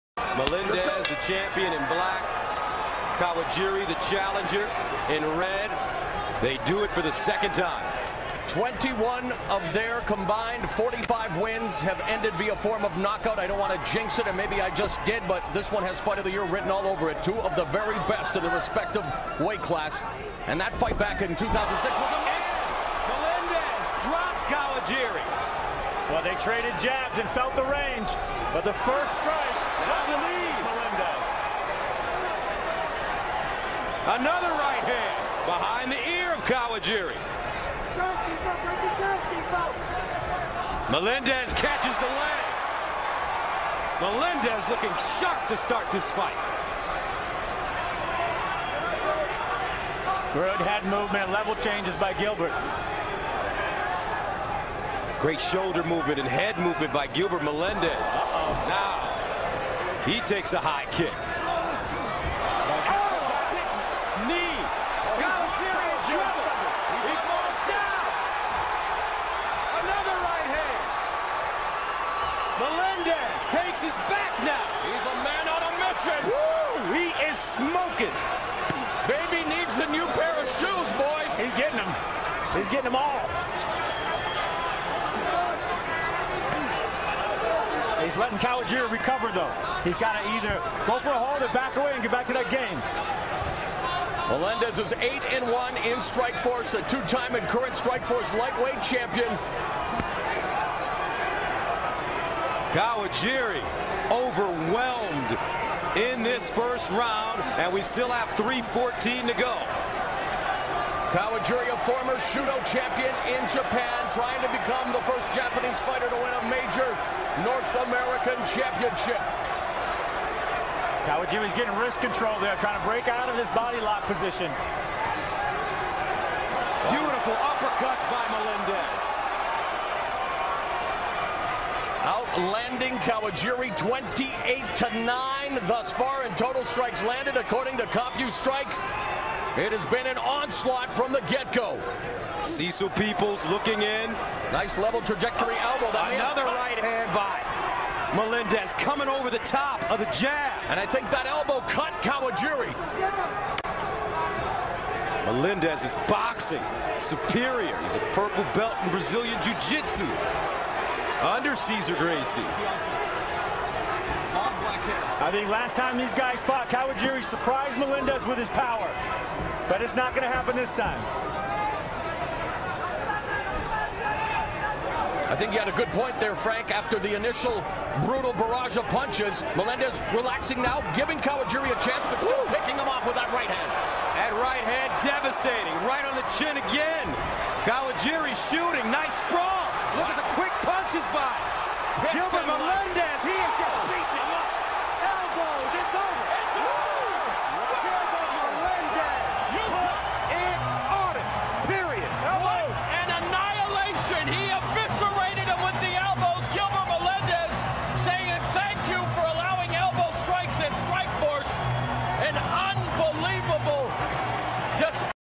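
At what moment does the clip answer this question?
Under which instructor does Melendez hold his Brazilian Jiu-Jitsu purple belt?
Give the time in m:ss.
2:41.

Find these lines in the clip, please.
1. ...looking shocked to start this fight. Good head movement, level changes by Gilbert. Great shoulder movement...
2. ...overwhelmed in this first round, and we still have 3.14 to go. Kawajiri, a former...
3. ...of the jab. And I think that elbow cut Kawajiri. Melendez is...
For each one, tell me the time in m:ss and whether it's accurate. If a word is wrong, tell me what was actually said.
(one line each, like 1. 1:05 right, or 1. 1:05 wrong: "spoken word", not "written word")
1. 0:44 right
2. 1:44 right
3. 2:29 right.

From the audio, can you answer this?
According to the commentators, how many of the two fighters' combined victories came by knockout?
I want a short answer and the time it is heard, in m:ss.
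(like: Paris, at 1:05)
21, at 0:08.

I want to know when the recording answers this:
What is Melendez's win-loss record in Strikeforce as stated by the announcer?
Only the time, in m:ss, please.
1:34.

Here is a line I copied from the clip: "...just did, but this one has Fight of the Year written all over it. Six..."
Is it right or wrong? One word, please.
wrong.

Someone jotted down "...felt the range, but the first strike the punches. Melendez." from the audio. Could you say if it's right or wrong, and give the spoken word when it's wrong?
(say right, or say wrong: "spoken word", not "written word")
wrong: "knees", not "punches".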